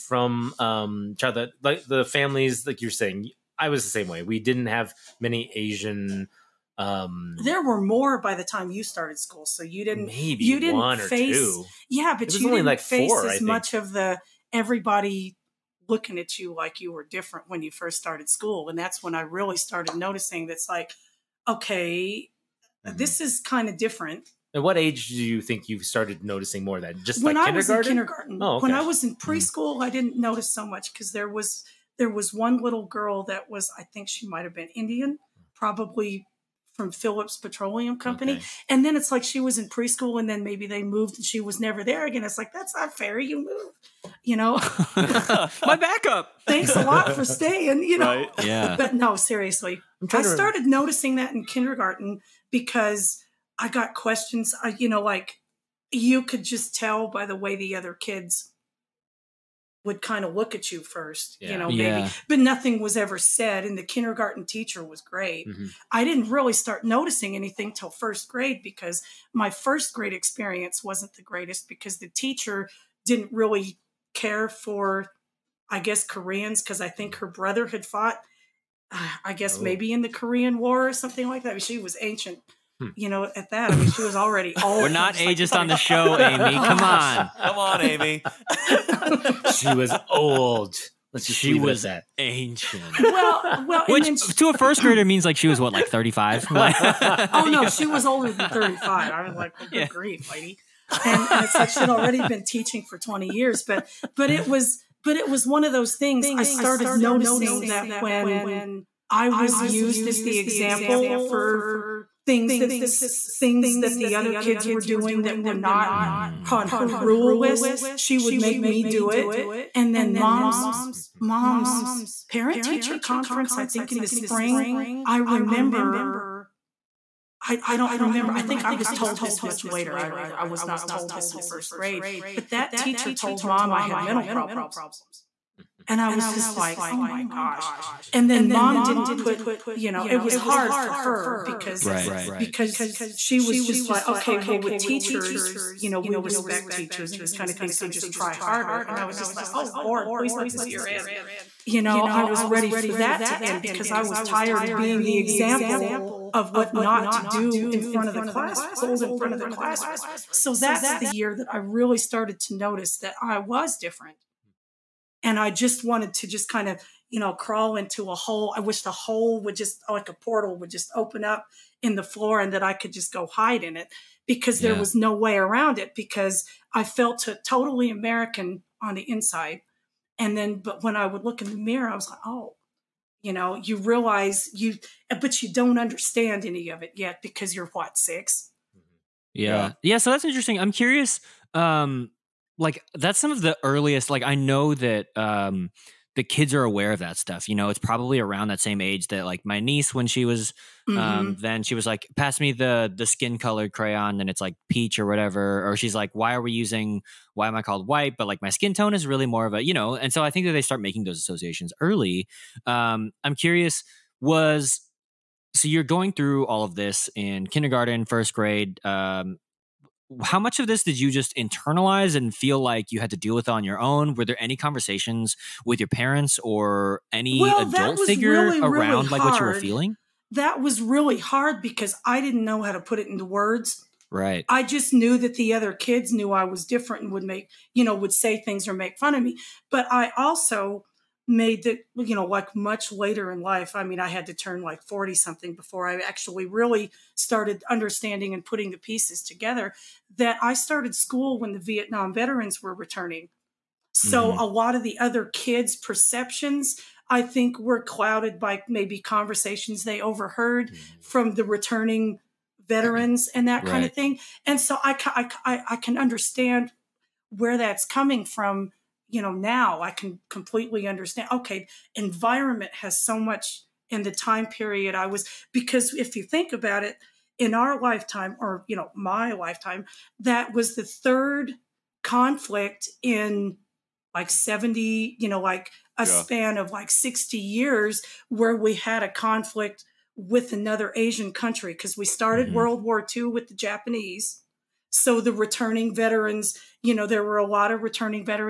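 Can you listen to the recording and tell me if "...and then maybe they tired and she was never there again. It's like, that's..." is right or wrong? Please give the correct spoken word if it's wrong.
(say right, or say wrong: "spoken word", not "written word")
wrong: "moved", not "tired".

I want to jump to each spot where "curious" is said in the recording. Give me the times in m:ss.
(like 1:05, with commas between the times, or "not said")
3:10, 3:33.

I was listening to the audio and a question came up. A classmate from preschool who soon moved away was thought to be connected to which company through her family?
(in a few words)
Phillips Petroleum Company.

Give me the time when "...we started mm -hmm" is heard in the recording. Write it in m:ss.
4:51.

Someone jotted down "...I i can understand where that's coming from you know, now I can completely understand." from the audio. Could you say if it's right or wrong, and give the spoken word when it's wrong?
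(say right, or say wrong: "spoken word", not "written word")
right.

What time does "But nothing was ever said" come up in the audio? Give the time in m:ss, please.
1:02.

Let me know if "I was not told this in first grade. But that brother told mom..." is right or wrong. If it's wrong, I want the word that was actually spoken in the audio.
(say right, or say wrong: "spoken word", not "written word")
wrong: "teacher", not "brother".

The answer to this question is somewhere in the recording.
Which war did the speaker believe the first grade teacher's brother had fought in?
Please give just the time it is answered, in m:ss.
1:20.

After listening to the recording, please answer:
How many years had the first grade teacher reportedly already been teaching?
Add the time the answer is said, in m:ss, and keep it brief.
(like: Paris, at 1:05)
20, at 1:42.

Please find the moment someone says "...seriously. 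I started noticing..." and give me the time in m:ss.
0:49.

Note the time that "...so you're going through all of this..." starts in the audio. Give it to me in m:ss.
3:35.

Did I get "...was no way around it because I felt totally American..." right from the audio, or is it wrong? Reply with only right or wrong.
right.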